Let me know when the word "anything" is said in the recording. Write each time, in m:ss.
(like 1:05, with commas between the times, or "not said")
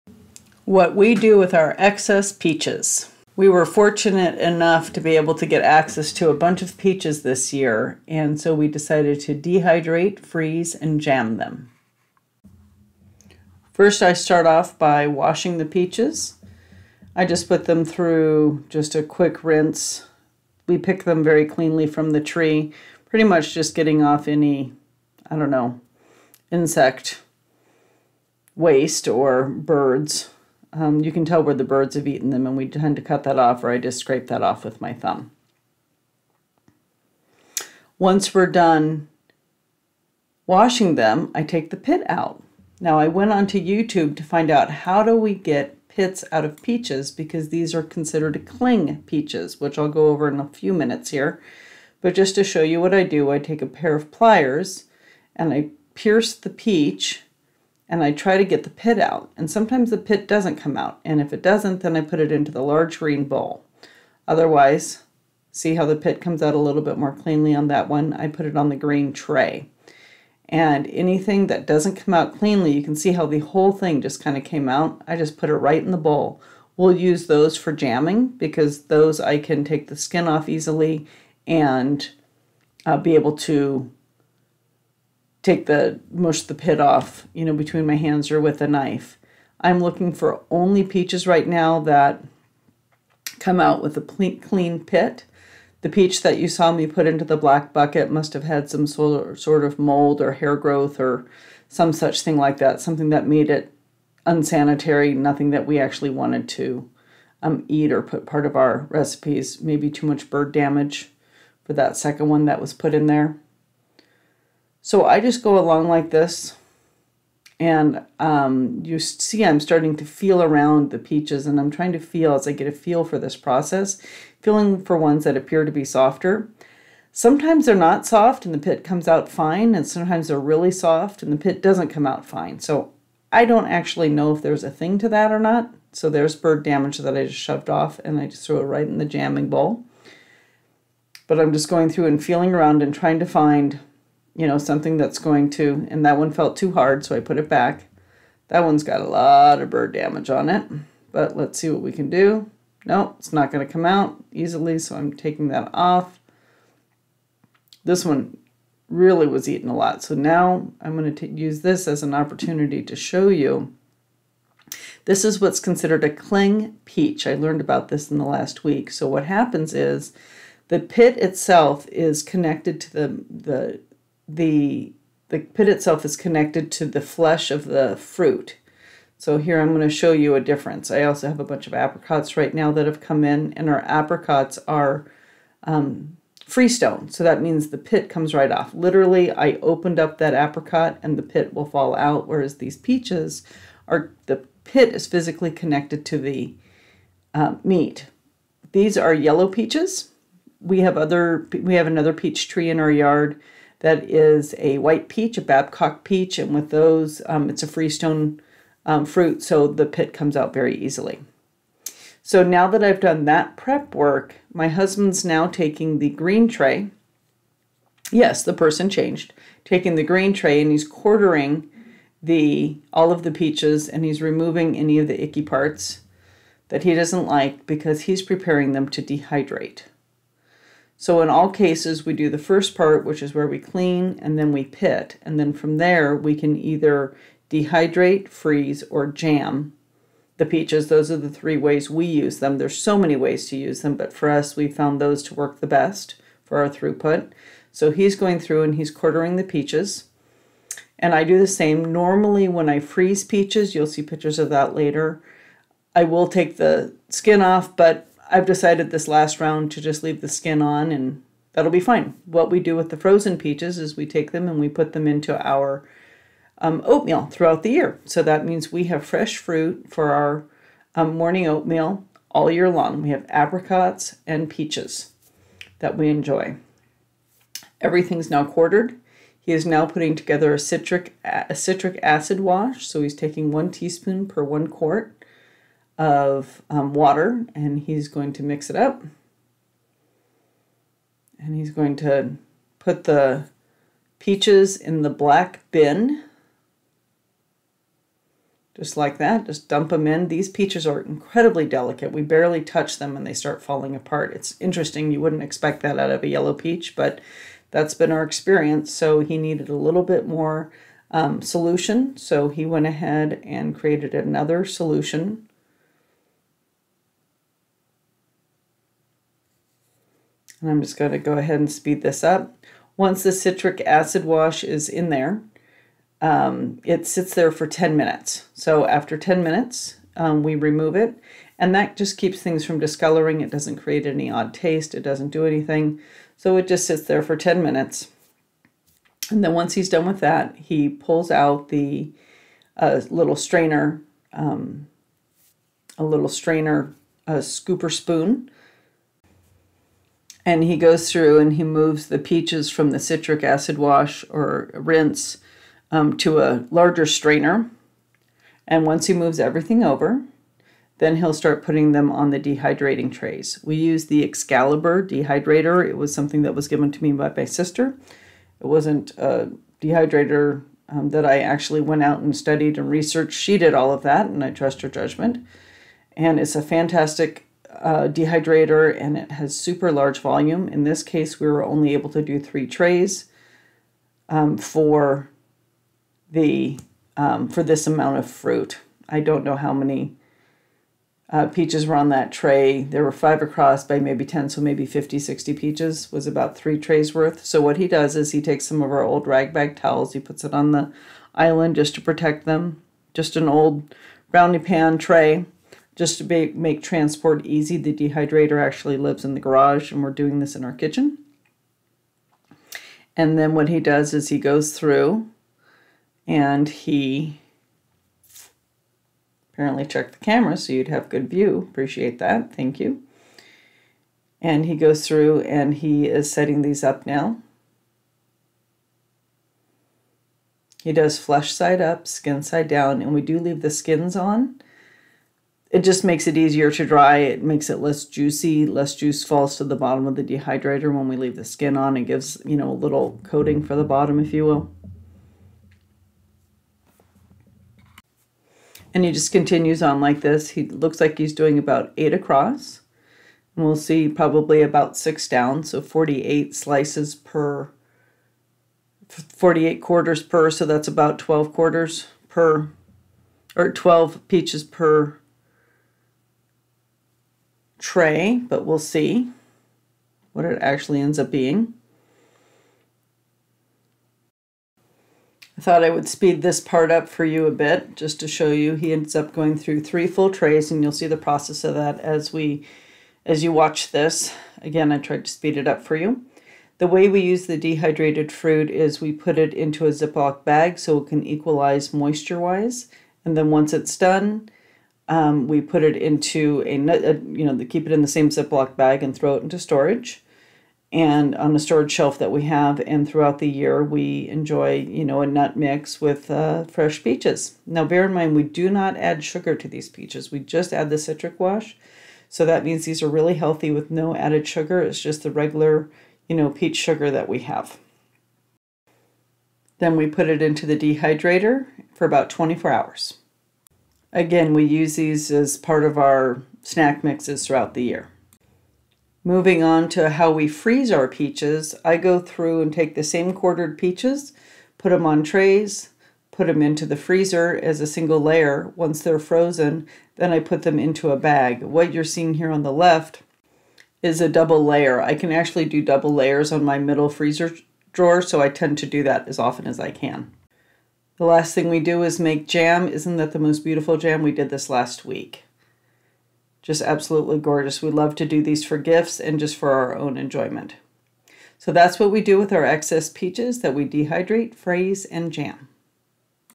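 1:10, 5:35.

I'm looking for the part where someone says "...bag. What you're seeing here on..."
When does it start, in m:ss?
9:01.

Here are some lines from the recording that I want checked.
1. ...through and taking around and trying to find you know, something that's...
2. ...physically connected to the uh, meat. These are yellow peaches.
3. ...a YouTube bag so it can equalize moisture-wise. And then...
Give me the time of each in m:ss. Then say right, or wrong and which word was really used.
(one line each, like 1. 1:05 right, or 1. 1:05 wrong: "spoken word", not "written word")
1. 2:21 wrong: "feeling", not "taking"
2. 3:15 right
3. 8:09 wrong: "Ziploc", not "YouTube".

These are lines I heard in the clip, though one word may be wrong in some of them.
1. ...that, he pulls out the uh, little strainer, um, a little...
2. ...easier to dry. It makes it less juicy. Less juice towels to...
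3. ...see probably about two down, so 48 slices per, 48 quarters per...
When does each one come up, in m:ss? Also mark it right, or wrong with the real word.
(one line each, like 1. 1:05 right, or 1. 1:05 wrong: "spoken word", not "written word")
1. 5:40 right
2. 7:16 wrong: "falls", not "towels"
3. 7:33 wrong: "six", not "two".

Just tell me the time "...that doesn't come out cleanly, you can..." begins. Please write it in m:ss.
1:11.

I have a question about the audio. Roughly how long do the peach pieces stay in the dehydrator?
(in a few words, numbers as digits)
24 hours.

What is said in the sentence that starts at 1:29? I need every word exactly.
I'm looking for only peaches right now that come out with a clean pit.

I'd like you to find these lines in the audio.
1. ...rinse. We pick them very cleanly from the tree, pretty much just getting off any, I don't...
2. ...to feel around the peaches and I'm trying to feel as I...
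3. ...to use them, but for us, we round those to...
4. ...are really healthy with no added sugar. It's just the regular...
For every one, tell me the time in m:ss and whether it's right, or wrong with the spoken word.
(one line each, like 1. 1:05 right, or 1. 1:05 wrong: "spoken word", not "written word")
1. 0:19 right
2. 1:59 right
3. 4:03 wrong: "found", not "round"
4. 8:33 right.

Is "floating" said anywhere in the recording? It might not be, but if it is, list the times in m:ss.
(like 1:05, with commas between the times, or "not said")
not said.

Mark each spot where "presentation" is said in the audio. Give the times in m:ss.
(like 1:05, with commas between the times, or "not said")
not said.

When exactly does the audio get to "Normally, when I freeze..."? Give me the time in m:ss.
4:11.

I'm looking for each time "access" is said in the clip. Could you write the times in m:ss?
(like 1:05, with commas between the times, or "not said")
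0:05.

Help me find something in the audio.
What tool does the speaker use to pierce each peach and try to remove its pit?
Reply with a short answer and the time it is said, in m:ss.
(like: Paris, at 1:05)
pliers, at 0:53.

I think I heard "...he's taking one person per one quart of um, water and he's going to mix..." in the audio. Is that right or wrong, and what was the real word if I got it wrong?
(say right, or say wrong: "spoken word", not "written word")
wrong: "teaspoon", not "person".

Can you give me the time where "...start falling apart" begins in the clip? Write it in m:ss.
5:03.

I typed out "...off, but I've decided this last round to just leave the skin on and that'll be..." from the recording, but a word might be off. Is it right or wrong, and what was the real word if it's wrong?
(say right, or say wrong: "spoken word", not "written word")
right.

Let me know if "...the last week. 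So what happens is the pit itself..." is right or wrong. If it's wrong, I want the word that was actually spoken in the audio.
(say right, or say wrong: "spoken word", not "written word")
right.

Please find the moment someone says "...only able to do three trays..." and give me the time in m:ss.
6:21.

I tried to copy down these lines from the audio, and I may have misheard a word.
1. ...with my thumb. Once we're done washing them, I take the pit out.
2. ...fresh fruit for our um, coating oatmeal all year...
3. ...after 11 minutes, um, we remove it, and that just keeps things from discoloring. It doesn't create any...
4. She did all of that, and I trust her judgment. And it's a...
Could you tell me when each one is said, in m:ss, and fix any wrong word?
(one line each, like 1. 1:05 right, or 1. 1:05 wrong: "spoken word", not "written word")
1. 0:34 right
2. 4:29 wrong: "morning", not "coating"
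3. 5:28 wrong: "10", not "11"
4. 6:13 right.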